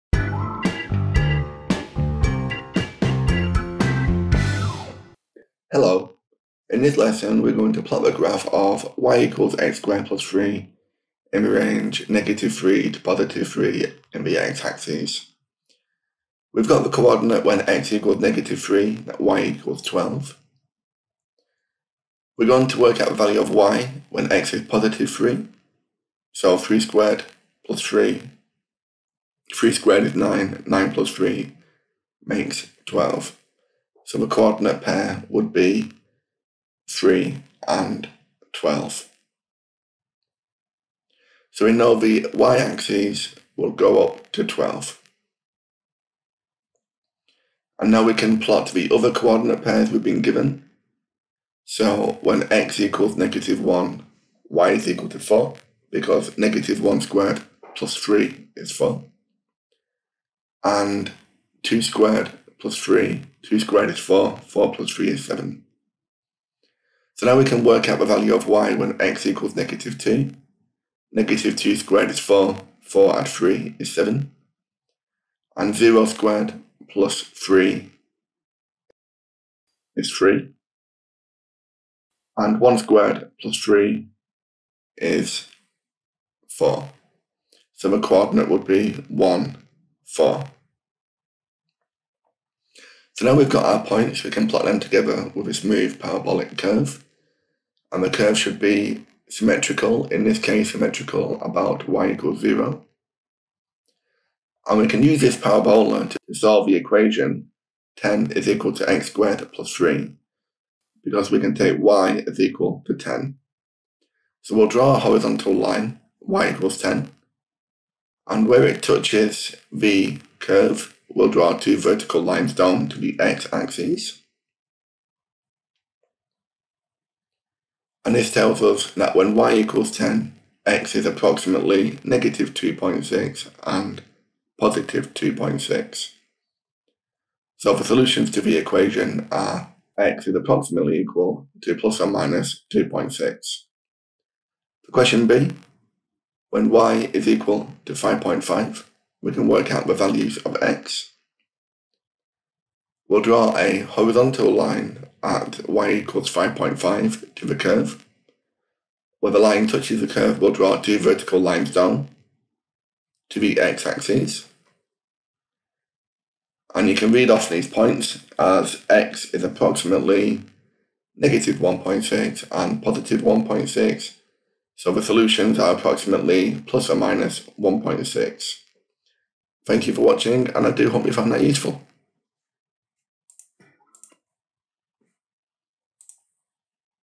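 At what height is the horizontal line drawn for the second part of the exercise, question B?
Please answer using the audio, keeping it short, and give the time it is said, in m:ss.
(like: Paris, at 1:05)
5.5, at 2:35.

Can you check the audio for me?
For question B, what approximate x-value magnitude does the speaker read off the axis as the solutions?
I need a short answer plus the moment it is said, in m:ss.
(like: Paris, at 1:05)
plus or minus 1.6, at 2:56.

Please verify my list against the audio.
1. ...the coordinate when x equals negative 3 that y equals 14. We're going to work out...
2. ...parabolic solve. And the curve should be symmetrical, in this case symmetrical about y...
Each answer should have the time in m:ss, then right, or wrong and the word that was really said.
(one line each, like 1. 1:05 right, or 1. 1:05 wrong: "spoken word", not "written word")
1. 0:16 wrong: "12", not "14"
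2. 1:35 wrong: "curve", not "solve".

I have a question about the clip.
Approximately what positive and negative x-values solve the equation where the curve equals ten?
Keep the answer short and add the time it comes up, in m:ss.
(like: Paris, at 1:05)
plus or minus 2.6, at 2:21.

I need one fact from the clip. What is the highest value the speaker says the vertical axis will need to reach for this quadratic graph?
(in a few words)
12.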